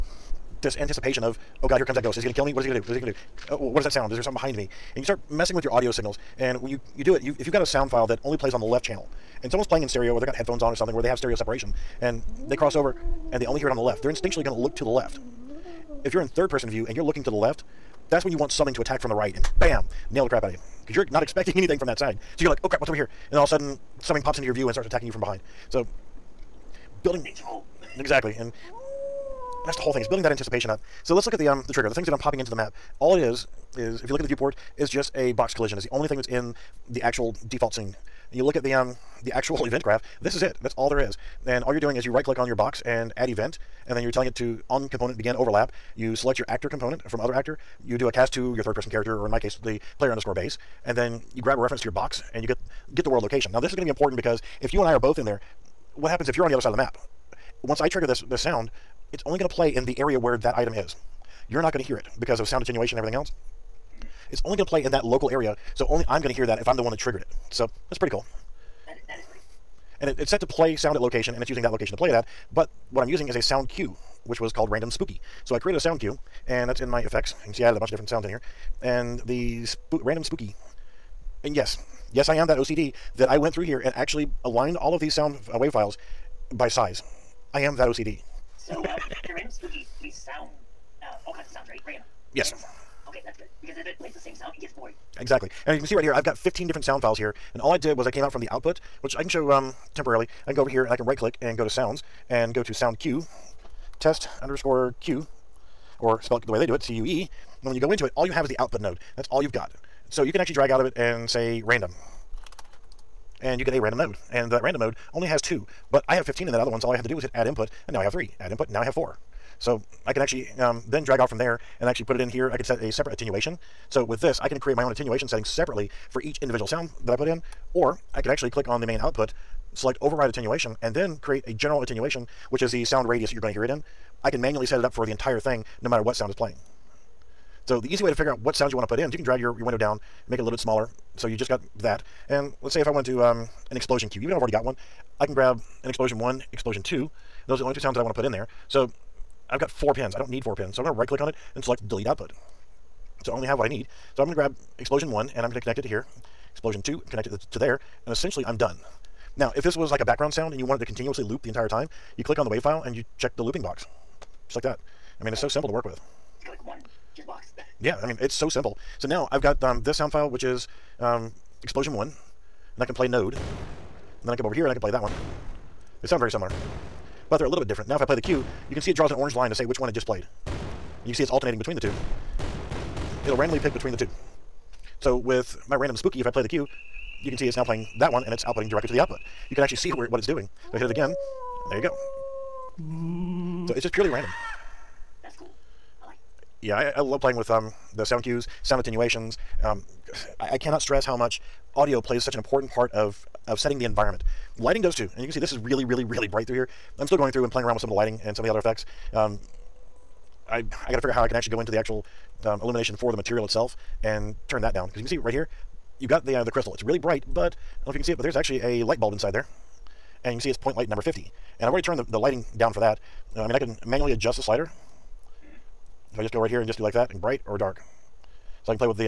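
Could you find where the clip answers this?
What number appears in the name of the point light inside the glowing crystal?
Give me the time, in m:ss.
3:40.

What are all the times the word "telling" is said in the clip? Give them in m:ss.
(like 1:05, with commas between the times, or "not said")
0:44.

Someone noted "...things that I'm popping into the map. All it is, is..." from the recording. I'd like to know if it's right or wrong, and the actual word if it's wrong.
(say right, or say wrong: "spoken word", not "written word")
right.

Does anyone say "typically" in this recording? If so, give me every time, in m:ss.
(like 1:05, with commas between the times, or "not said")
not said.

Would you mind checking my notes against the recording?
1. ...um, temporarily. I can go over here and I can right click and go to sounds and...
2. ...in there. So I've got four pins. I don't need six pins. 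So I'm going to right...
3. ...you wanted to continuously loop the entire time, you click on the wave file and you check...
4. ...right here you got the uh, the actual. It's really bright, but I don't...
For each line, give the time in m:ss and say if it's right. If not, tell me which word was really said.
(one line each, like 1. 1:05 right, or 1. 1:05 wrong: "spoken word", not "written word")
1. 1:39 right
2. 2:28 wrong: "four", not "six"
3. 2:40 right
4. 3:35 wrong: "crystal", not "actual".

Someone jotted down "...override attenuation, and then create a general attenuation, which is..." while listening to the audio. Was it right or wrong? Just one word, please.
right.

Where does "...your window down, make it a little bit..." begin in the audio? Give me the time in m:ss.
2:19.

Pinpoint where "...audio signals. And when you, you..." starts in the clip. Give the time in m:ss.
0:05.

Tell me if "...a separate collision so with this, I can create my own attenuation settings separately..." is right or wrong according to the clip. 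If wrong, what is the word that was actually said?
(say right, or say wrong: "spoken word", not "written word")
wrong: "attenuation", not "collision".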